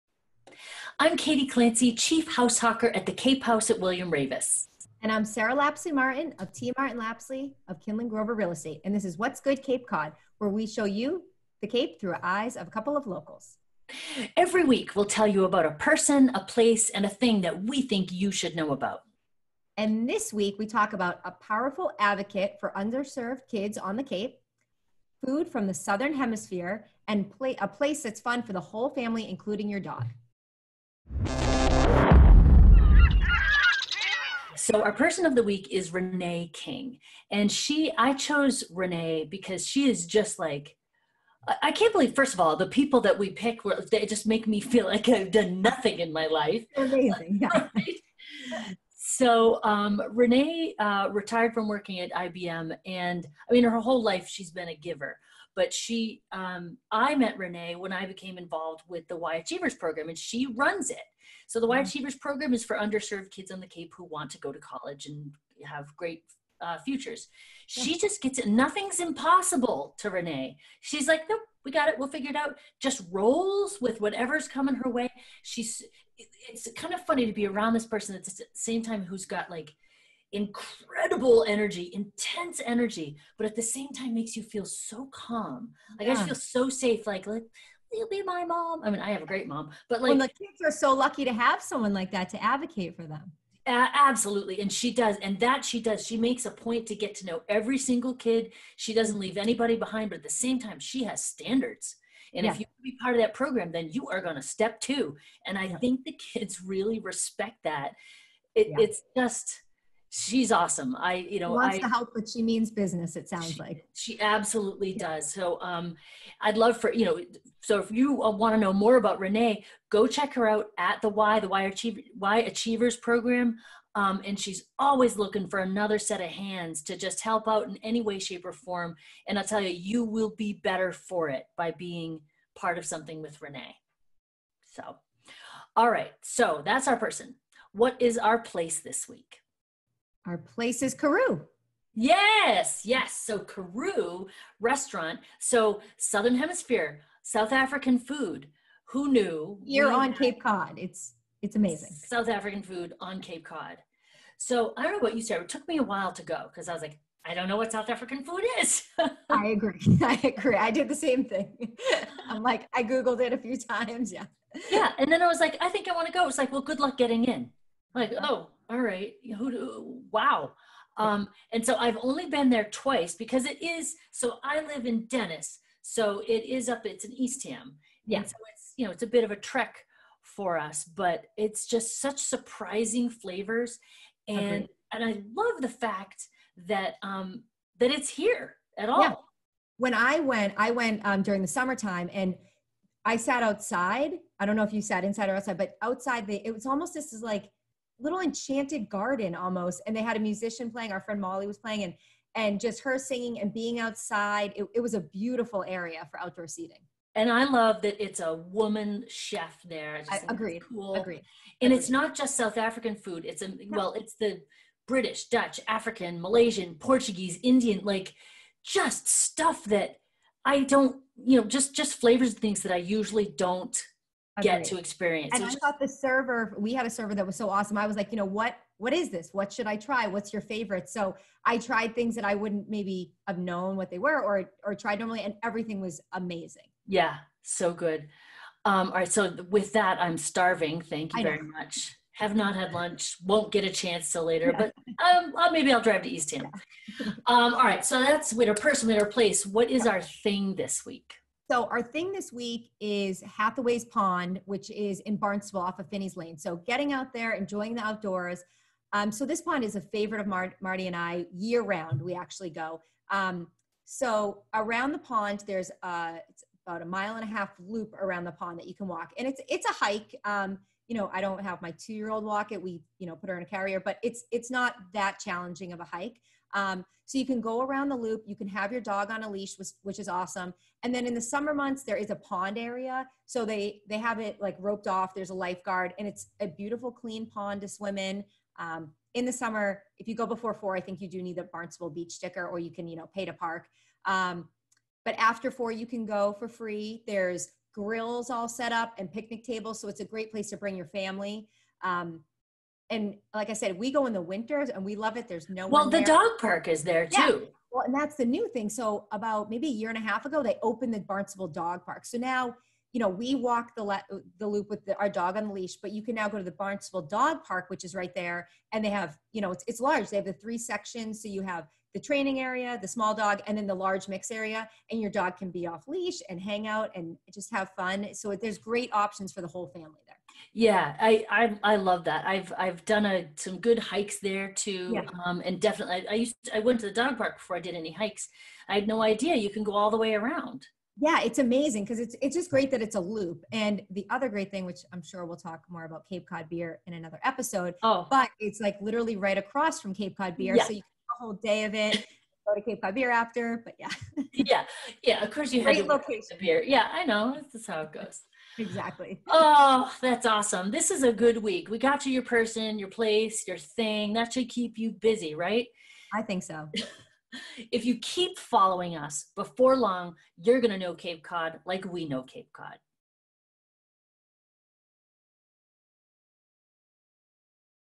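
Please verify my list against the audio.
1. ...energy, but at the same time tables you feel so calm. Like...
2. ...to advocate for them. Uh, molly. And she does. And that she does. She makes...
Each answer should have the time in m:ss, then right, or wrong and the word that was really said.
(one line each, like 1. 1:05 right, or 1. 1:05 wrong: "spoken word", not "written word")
1. 1:22 wrong: "makes", not "tables"
2. 1:32 wrong: "absolutely", not "molly".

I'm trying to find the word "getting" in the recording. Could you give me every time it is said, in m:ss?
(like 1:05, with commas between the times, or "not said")
2:46, 4:16.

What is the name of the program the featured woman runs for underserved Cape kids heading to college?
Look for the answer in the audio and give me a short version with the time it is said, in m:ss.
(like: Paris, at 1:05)
Y Achievers, at 0:59.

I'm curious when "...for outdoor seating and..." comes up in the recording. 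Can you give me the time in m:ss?
3:26.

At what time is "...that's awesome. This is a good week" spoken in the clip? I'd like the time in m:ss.
6:00.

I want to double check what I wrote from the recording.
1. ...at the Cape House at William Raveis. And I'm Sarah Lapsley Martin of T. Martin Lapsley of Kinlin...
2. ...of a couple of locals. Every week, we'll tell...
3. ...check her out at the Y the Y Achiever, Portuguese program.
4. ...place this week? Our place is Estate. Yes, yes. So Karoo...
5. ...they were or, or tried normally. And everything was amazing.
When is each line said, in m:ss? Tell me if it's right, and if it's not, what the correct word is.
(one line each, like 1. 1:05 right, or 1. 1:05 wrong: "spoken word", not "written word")
1. 0:02 right
2. 0:12 right
3. 2:00 wrong: "Achievers", not "Portuguese"
4. 2:18 wrong: "Karoo", not "Estate"
5. 3:53 right.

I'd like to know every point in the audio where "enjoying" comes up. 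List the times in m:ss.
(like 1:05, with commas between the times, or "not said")
4:17.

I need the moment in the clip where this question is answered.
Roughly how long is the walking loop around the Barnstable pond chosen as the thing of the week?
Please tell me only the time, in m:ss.
4:26.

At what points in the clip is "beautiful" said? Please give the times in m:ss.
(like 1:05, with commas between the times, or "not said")
3:24, 4:46.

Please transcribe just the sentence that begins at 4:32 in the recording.
We, you know, put her in a carrier, but it's it's not that challenging of a hike.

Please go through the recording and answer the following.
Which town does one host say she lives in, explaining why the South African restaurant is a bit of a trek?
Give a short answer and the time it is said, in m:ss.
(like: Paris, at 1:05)
Dennis, at 2:55.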